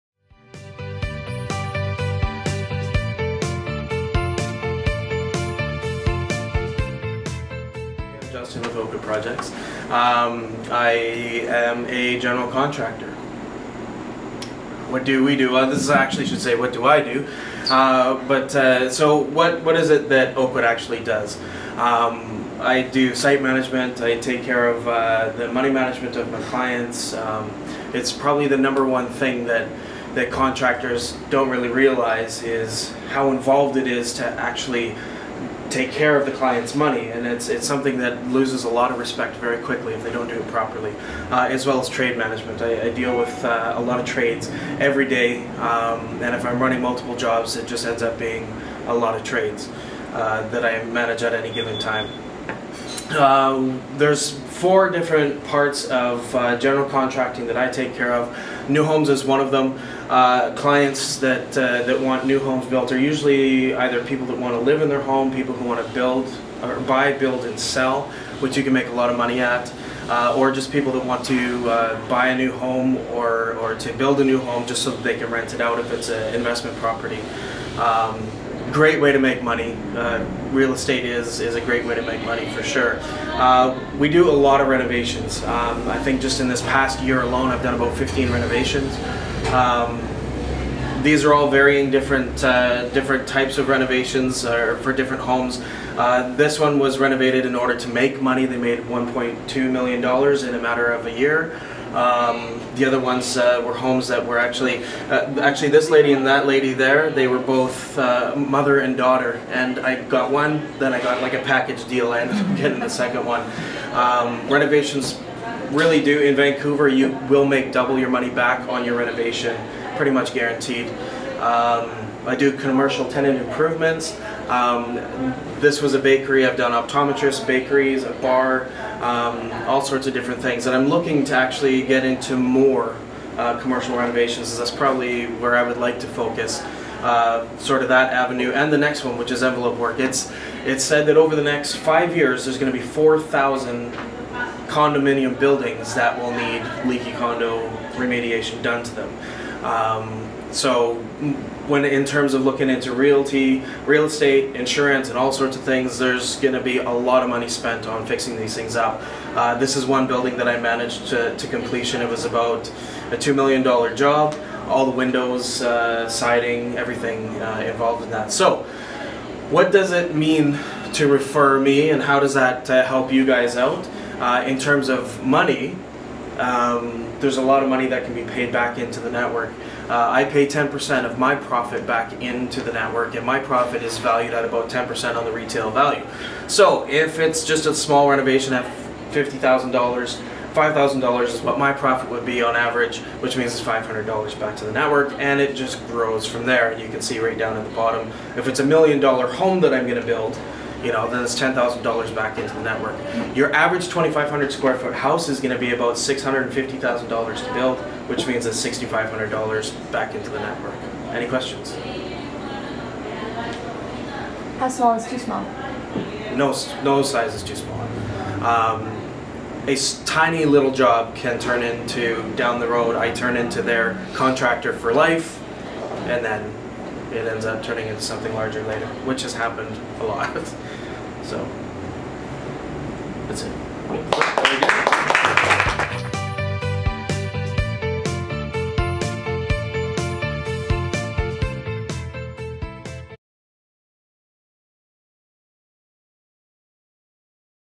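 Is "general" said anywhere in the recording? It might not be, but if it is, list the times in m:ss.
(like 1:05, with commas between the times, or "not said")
0:12, 0:56.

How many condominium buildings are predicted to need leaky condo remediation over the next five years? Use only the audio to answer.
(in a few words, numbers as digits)
4,000.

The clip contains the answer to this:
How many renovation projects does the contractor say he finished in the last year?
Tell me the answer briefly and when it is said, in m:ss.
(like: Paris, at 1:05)
15, at 1:27.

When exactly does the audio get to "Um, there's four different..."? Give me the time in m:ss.
0:53.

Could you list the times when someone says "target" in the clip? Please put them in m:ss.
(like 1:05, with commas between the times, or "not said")
not said.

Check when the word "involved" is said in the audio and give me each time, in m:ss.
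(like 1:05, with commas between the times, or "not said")
0:33, 2:47.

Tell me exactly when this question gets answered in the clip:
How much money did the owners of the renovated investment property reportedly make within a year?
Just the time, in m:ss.
1:38.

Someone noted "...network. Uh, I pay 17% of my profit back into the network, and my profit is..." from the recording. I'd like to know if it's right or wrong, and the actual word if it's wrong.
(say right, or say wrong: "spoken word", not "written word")
wrong: "10", not "17".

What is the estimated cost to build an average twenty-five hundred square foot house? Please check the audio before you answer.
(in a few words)
$650,000.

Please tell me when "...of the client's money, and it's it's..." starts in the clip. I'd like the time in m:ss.
0:36.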